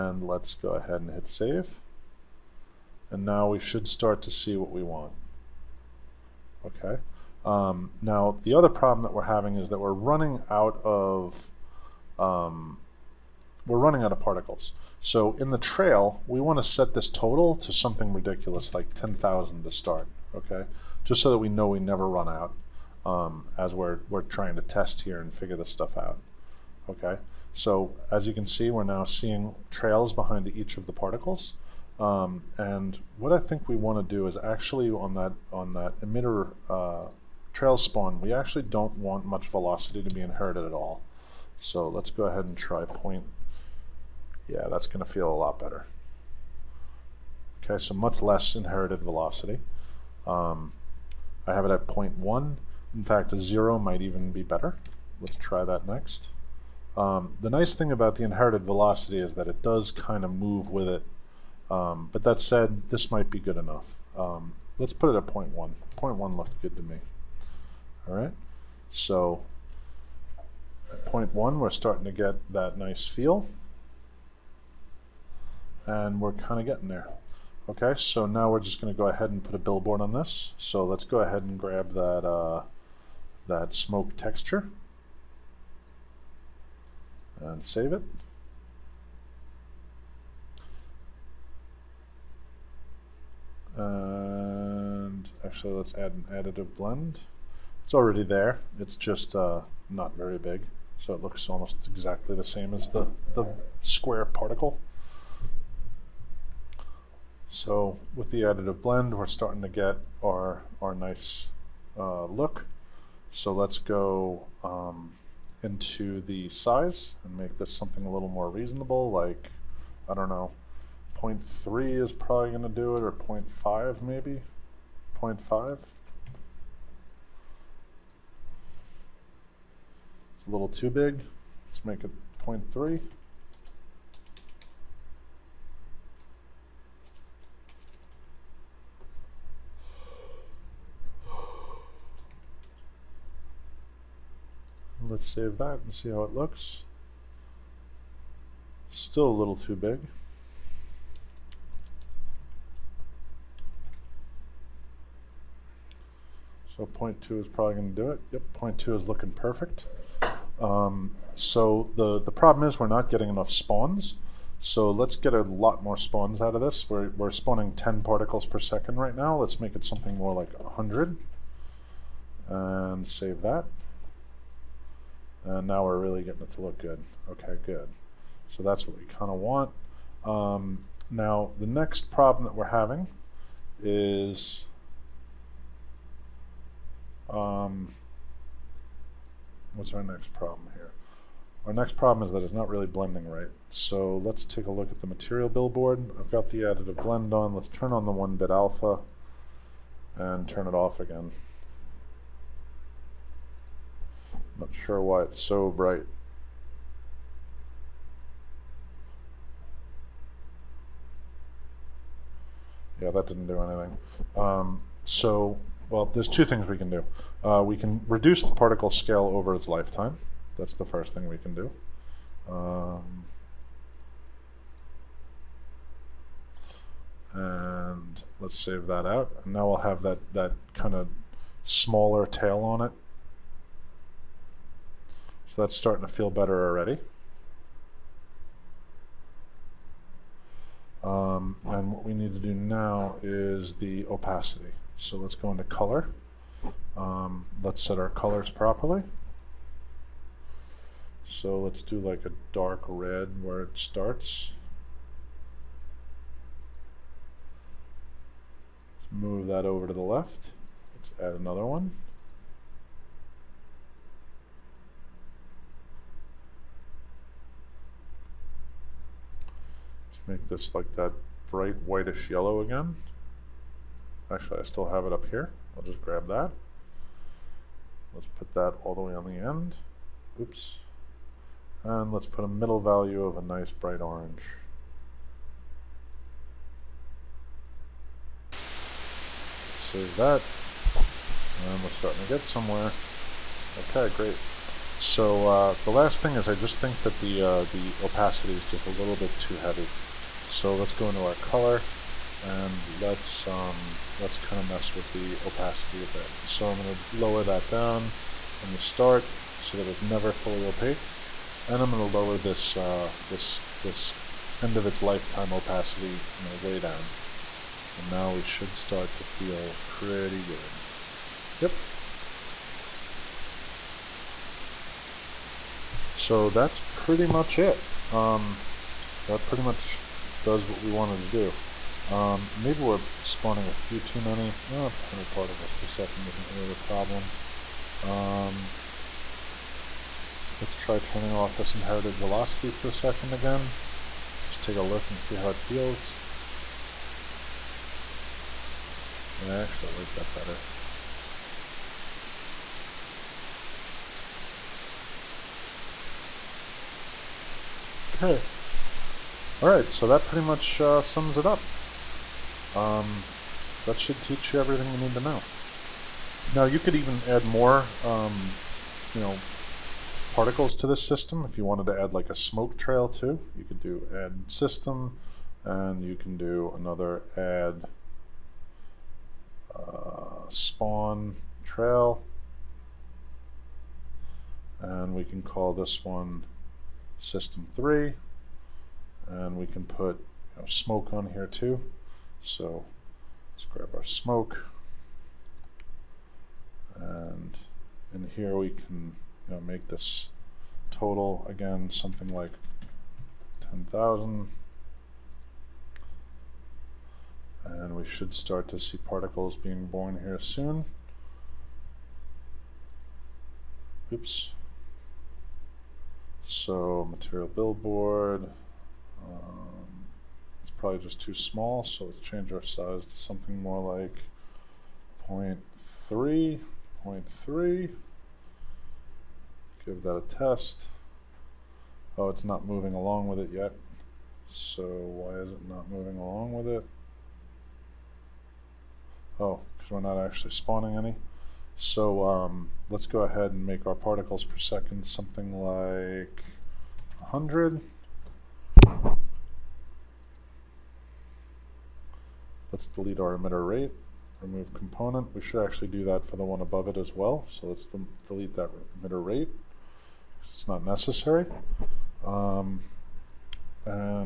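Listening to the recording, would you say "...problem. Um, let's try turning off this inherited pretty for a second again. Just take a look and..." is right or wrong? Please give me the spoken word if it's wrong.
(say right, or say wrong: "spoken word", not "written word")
wrong: "velocity", not "pretty".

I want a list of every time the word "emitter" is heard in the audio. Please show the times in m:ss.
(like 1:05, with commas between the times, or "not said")
0:35, 7:33, 7:39.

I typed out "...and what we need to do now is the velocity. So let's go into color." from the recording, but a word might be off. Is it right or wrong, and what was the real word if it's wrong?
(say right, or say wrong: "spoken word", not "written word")
wrong: "opacity", not "velocity".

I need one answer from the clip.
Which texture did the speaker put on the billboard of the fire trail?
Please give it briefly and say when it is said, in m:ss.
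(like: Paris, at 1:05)
smoke texture, at 1:23.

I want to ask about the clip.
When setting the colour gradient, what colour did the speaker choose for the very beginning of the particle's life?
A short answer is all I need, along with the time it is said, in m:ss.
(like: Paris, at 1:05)
dark red, at 4:12.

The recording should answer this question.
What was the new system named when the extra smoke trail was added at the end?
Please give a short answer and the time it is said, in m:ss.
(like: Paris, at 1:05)
system three, at 6:27.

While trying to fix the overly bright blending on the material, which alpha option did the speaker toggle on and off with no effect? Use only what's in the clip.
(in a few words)
1-bit alpha.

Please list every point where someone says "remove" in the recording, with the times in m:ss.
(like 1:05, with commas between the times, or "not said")
7:34.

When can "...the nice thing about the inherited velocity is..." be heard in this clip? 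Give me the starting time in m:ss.
0:57.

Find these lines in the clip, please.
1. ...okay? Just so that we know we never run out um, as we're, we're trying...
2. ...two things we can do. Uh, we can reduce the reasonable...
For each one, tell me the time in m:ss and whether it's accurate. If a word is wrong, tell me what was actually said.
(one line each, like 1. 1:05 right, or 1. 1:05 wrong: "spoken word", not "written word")
1. 0:20 right
2. 3:36 wrong: "particle", not "reasonable".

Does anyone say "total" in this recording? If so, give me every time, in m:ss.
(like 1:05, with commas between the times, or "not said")
0:17, 6:40.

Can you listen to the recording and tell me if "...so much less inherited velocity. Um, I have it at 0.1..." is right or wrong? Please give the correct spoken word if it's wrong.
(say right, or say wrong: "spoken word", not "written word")
right.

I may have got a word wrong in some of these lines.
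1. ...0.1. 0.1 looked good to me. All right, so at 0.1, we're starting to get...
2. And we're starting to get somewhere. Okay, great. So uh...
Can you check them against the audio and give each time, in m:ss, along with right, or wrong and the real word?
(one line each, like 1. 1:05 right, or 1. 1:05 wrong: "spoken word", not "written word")
1. 1:05 right
2. 4:51 right.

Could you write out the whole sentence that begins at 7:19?
Oh, because we're not actually spawning any.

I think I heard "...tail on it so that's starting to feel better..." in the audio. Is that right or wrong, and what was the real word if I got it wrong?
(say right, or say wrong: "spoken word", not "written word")
right.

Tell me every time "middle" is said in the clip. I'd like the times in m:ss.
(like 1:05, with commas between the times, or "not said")
4:42.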